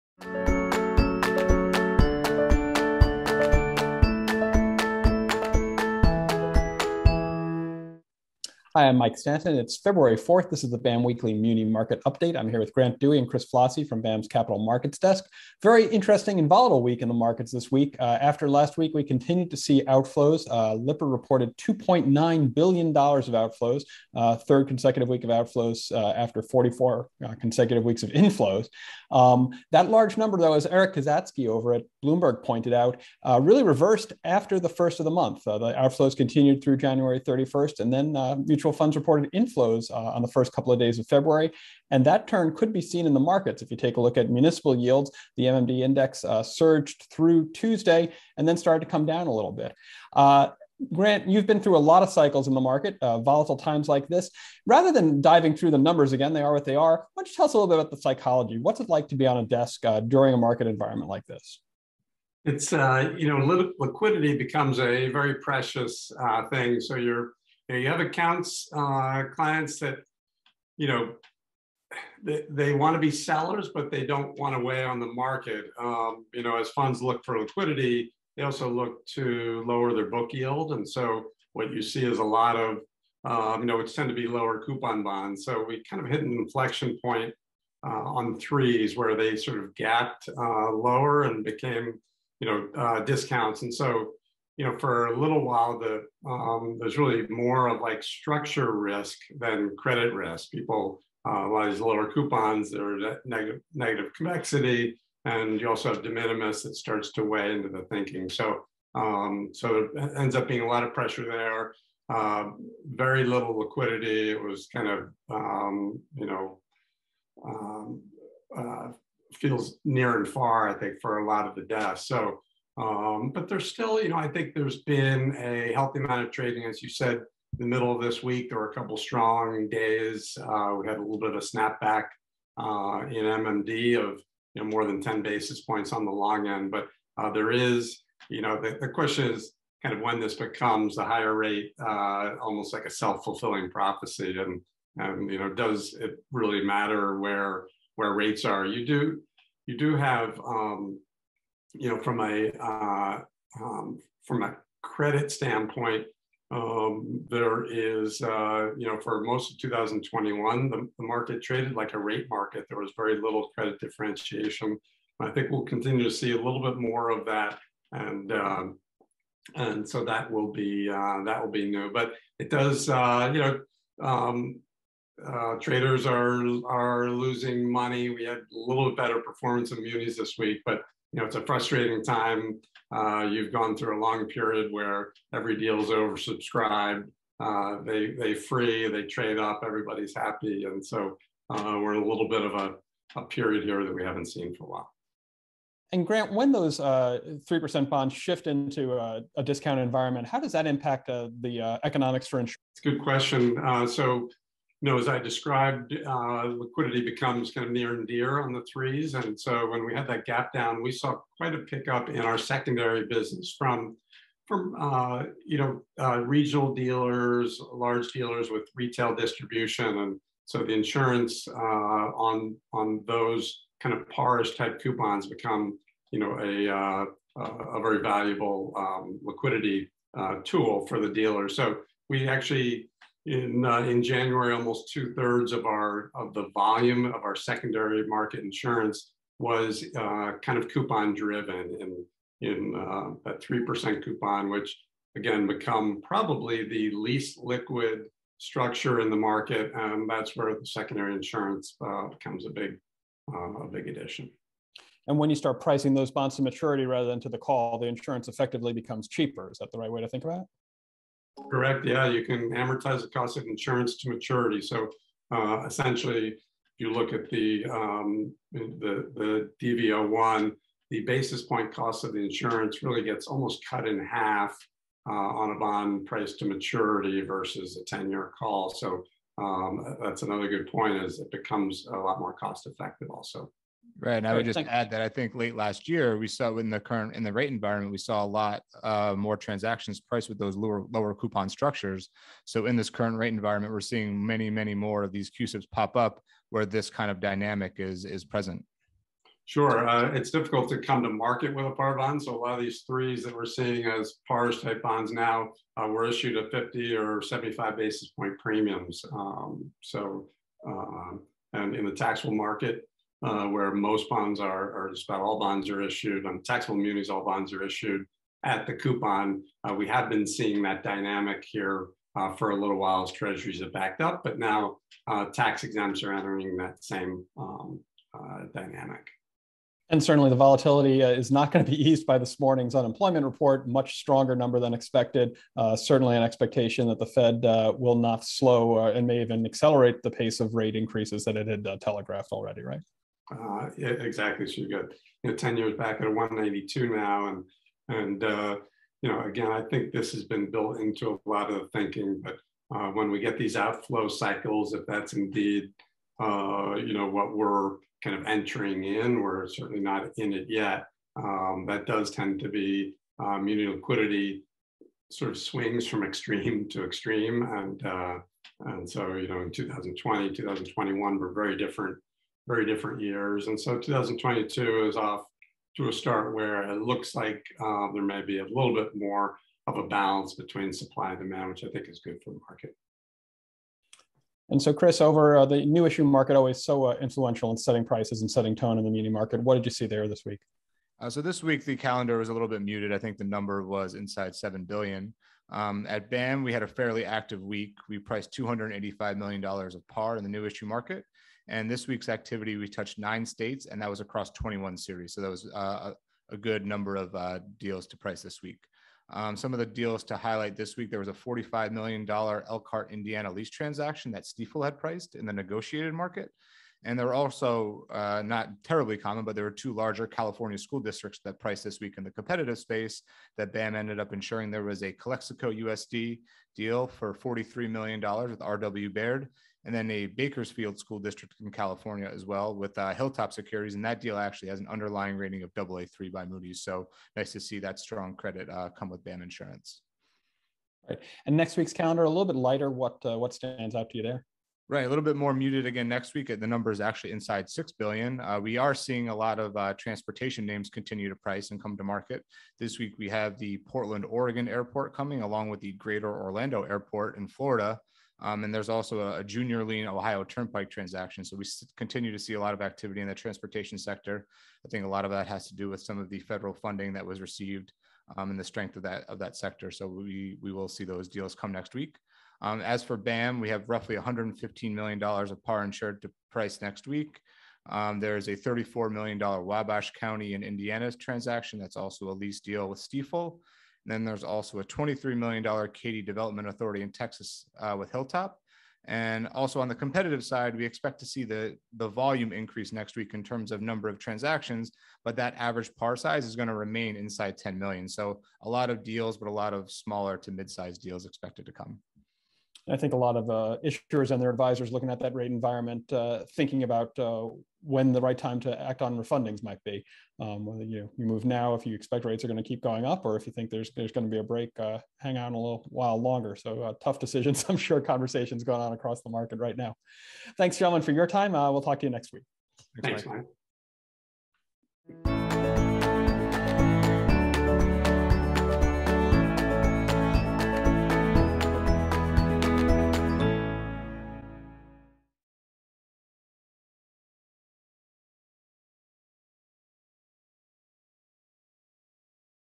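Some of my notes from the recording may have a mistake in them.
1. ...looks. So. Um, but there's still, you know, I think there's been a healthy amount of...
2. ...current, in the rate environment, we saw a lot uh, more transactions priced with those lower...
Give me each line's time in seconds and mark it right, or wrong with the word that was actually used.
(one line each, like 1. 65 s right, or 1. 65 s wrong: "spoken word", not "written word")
1. 121 s wrong: "desks", not "looks"
2. 286 s right.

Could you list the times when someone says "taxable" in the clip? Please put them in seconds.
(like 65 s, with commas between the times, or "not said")
311 s, 316 s.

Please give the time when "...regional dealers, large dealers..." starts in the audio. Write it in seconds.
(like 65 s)
216 s.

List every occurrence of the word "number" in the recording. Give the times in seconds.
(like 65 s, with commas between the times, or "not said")
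30 s, 55 s, 334 s, 393 s, 406 s, 446 s, 493 s.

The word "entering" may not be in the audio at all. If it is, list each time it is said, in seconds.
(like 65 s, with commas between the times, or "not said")
326 s, 358 s.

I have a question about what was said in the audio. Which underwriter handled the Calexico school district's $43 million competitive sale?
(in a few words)
RW Baird.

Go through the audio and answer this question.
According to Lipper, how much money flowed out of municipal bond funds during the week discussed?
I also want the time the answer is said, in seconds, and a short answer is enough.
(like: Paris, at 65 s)
$2.9 billion, at 21 s.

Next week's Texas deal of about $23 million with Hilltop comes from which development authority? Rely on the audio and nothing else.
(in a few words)
Katy Development Authority.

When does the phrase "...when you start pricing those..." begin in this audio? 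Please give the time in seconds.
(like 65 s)
255 s.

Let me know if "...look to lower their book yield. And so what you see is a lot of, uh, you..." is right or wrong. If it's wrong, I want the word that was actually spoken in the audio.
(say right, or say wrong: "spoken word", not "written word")
right.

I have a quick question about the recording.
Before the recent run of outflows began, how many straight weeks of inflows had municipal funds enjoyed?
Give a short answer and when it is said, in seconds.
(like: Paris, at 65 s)
44, at 26 s.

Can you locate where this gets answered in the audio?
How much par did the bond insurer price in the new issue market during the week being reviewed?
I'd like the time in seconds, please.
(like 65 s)
398 s.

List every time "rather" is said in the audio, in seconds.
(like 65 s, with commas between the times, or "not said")
54 s, 256 s.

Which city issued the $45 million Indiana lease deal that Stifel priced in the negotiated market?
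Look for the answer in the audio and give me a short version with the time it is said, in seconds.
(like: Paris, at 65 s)
Elkhart, at 412 s.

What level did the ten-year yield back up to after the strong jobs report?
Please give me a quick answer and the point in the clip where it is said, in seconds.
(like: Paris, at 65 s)
192, at 346 s.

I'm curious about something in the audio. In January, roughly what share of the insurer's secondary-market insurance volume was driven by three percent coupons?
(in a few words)
two thirds.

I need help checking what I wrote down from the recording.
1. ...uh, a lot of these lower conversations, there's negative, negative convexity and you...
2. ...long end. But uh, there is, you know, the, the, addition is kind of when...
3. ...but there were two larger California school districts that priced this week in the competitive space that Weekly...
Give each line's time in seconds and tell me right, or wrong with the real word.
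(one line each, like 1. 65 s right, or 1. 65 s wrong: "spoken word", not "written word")
1. 101 s wrong: "coupons", not "conversations"
2. 136 s wrong: "question", not "addition"
3. 419 s wrong: "BAM", not "Weekly".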